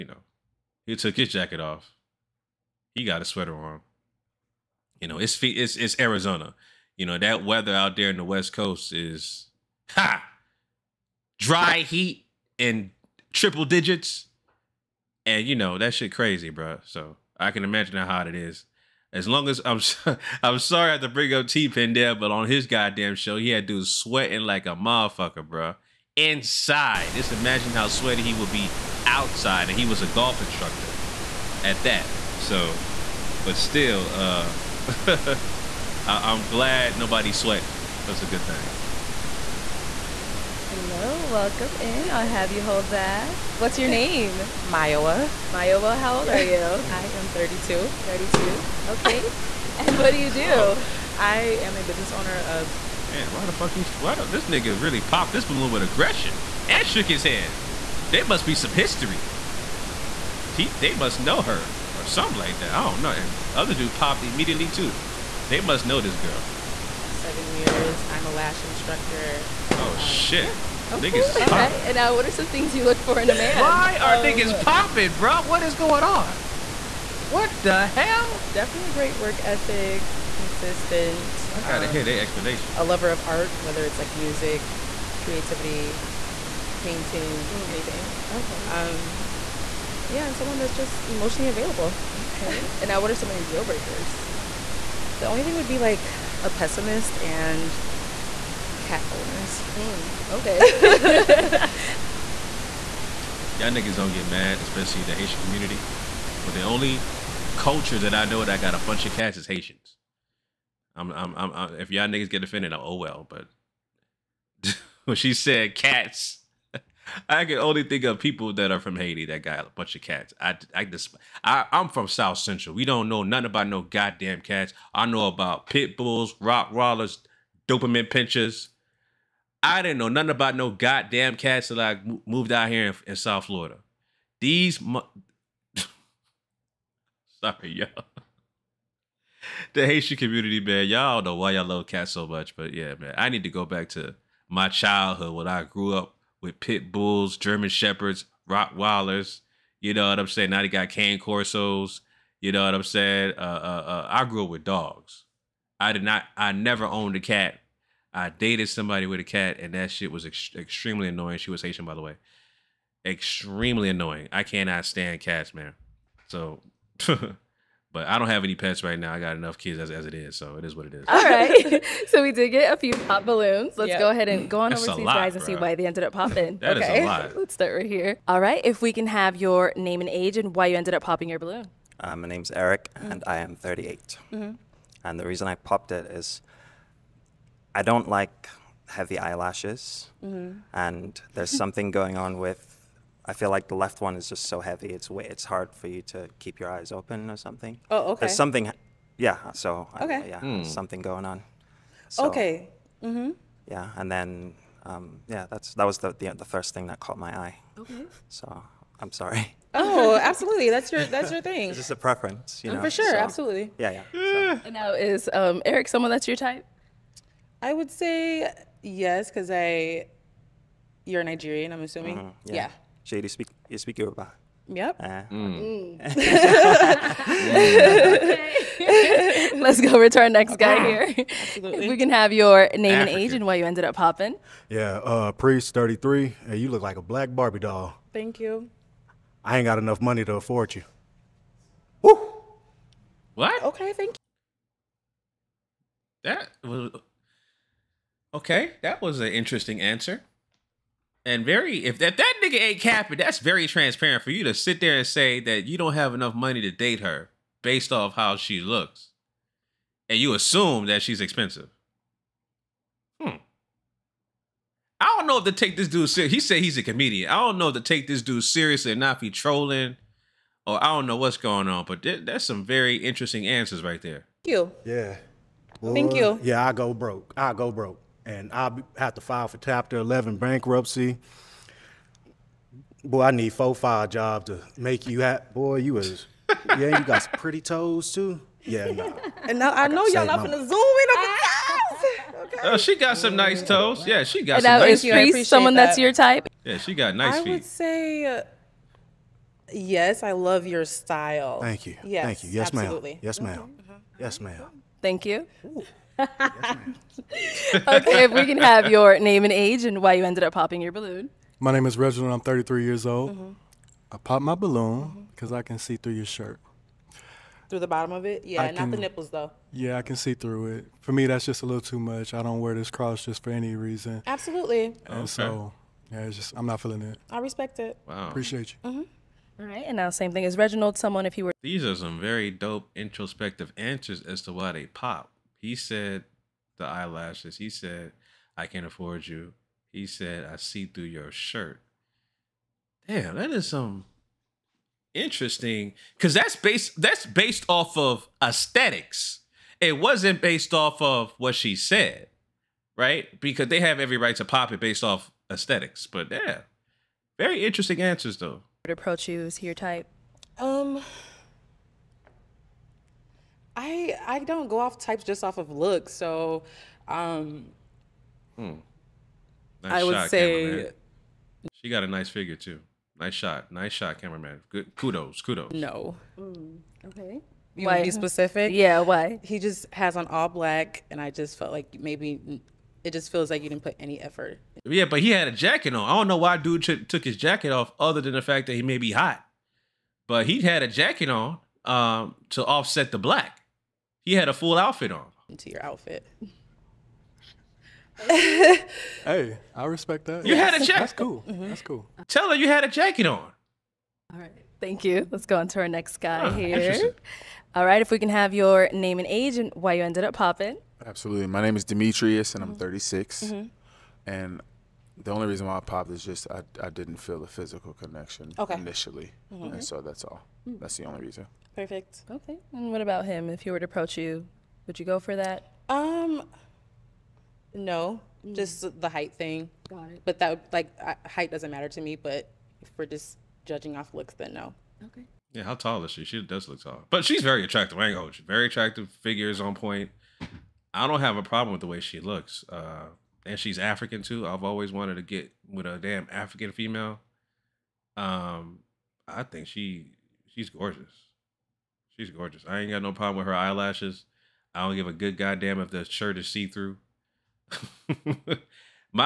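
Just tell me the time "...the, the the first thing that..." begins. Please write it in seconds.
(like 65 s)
205 s.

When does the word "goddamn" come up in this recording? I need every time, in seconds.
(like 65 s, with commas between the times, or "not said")
22 s, 123 s, 130 s, 455 s.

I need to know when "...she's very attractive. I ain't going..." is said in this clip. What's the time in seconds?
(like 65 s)
437 s.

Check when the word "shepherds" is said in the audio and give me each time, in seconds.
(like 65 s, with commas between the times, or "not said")
147 s.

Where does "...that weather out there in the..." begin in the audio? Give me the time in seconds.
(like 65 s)
7 s.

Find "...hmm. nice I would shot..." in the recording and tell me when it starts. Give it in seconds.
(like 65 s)
368 s.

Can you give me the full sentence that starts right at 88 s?
Um, yeah, and someone that's just emotionally available.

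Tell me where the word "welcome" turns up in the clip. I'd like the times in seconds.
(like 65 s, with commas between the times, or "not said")
41 s.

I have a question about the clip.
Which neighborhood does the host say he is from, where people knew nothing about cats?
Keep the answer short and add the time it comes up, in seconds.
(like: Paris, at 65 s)
South Central, at 122 s.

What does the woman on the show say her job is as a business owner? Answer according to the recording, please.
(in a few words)
Lash instructor.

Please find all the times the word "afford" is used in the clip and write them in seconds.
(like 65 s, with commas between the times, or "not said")
240 s, 338 s.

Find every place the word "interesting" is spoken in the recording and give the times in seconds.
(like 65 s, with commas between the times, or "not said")
249 s, 272 s, 345 s, 357 s.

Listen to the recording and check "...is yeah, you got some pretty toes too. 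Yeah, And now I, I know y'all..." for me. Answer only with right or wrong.
right.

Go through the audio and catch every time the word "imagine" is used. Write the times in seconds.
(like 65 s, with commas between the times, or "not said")
17 s, 27 s.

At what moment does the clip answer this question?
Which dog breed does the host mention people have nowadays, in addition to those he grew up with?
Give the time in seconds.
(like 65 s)
150 s.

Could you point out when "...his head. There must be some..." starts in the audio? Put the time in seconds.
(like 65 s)
57 s.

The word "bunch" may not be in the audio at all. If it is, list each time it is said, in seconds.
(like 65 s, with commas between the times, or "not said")
108 s, 119 s.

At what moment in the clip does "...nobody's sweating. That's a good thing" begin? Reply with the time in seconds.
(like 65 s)
36 s.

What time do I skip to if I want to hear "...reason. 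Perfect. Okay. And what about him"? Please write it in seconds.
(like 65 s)
421 s.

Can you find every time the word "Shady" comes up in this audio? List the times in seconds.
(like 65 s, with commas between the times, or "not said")
223 s.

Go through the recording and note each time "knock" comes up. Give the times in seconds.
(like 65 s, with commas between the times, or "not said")
not said.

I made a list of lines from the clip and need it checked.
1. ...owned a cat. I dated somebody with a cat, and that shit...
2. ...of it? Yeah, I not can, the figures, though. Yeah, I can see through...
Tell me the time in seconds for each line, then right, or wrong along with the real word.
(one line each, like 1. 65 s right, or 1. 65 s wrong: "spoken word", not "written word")
1. 156 s right
2. 318 s wrong: "nipples", not "figures".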